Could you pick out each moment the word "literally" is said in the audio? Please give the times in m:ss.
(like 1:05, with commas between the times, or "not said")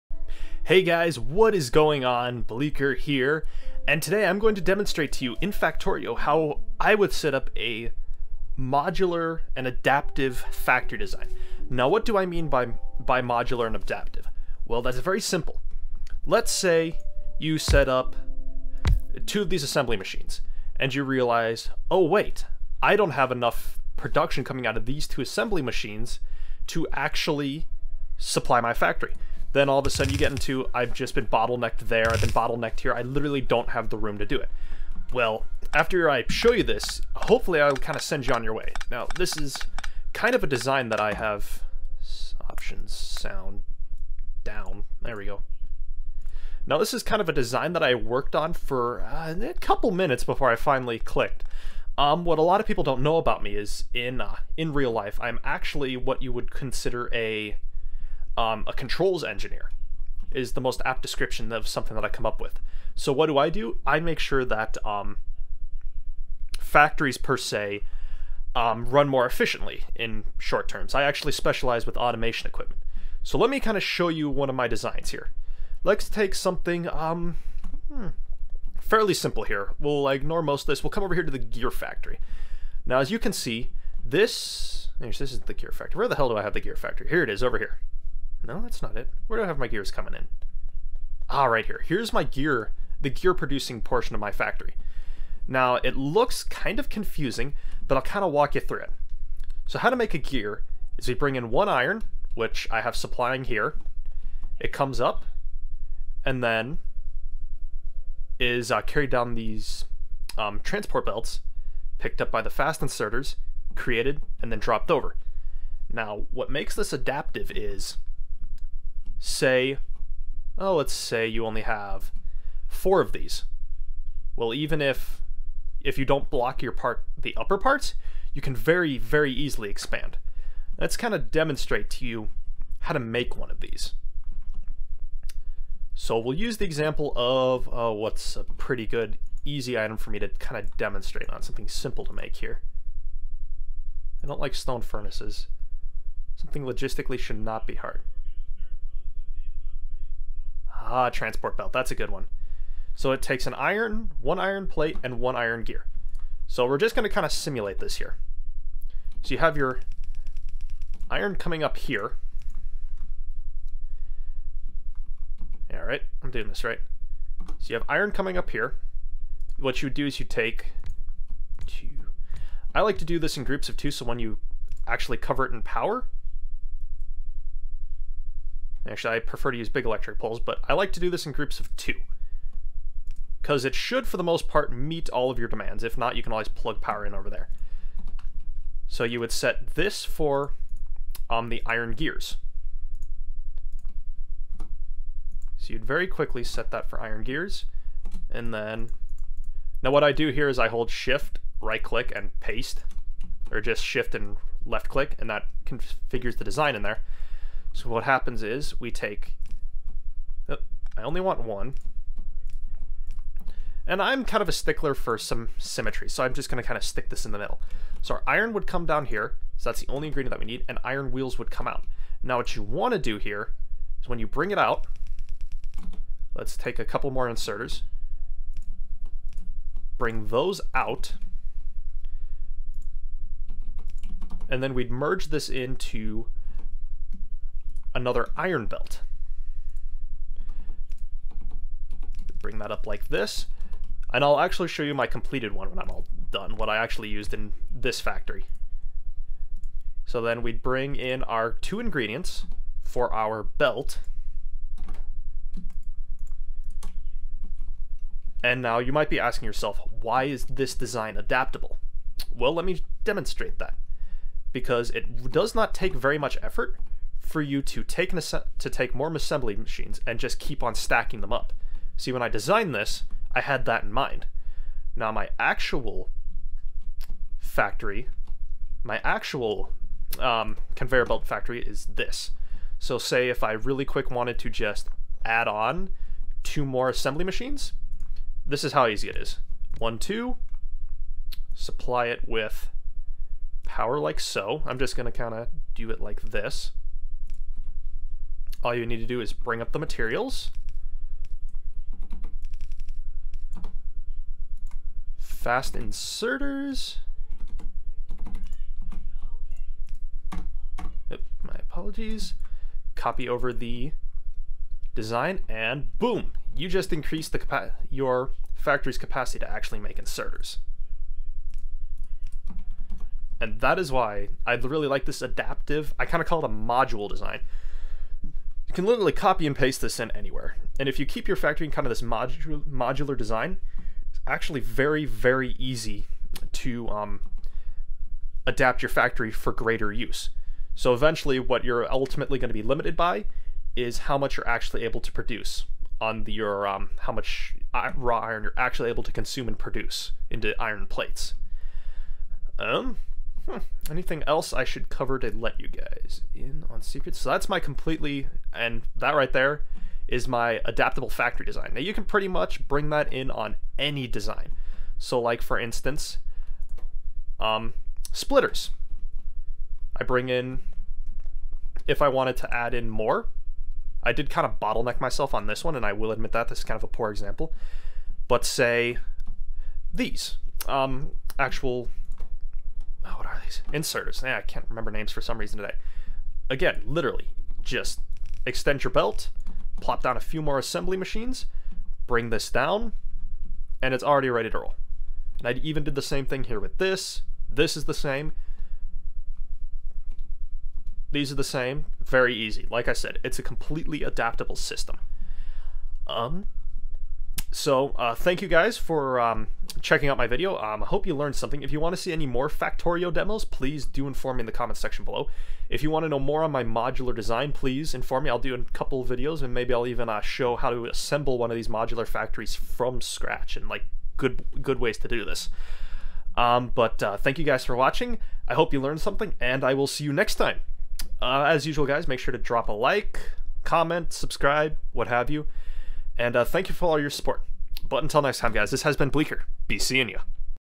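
0:33, 5:28, 6:26.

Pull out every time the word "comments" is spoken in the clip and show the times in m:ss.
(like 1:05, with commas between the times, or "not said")
6:54, 7:13.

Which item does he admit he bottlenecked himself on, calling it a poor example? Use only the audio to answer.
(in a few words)
Splitters.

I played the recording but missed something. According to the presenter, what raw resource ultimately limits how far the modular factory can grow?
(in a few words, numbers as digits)
Raw iron.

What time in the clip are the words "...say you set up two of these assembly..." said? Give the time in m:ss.
0:16.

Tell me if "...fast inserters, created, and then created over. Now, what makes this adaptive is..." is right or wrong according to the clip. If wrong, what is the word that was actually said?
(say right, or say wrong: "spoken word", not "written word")
wrong: "dropped", not "created".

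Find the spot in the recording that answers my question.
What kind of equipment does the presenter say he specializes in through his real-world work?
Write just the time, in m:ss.
1:11.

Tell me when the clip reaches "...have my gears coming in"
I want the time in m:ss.
1:29.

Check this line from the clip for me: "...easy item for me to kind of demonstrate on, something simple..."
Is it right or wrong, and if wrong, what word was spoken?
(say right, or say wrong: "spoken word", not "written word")
right.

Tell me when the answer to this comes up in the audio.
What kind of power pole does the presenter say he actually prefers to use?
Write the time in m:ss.
2:59.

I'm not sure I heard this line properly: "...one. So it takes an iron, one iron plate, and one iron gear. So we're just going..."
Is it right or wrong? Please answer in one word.
right.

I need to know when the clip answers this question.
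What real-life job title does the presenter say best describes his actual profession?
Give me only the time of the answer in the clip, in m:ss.
0:58.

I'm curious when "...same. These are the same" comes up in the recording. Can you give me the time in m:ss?
6:37.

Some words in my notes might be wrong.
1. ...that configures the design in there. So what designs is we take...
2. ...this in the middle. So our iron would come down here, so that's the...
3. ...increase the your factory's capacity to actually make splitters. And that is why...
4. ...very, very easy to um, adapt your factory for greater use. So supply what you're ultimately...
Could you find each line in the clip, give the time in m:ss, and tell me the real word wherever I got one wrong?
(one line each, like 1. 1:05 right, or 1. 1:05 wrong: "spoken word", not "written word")
1. 3:25 wrong: "happens", not "designs"
2. 3:37 right
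3. 5:16 wrong: "inserters", not "splitters"
4. 5:34 wrong: "eventually", not "supply".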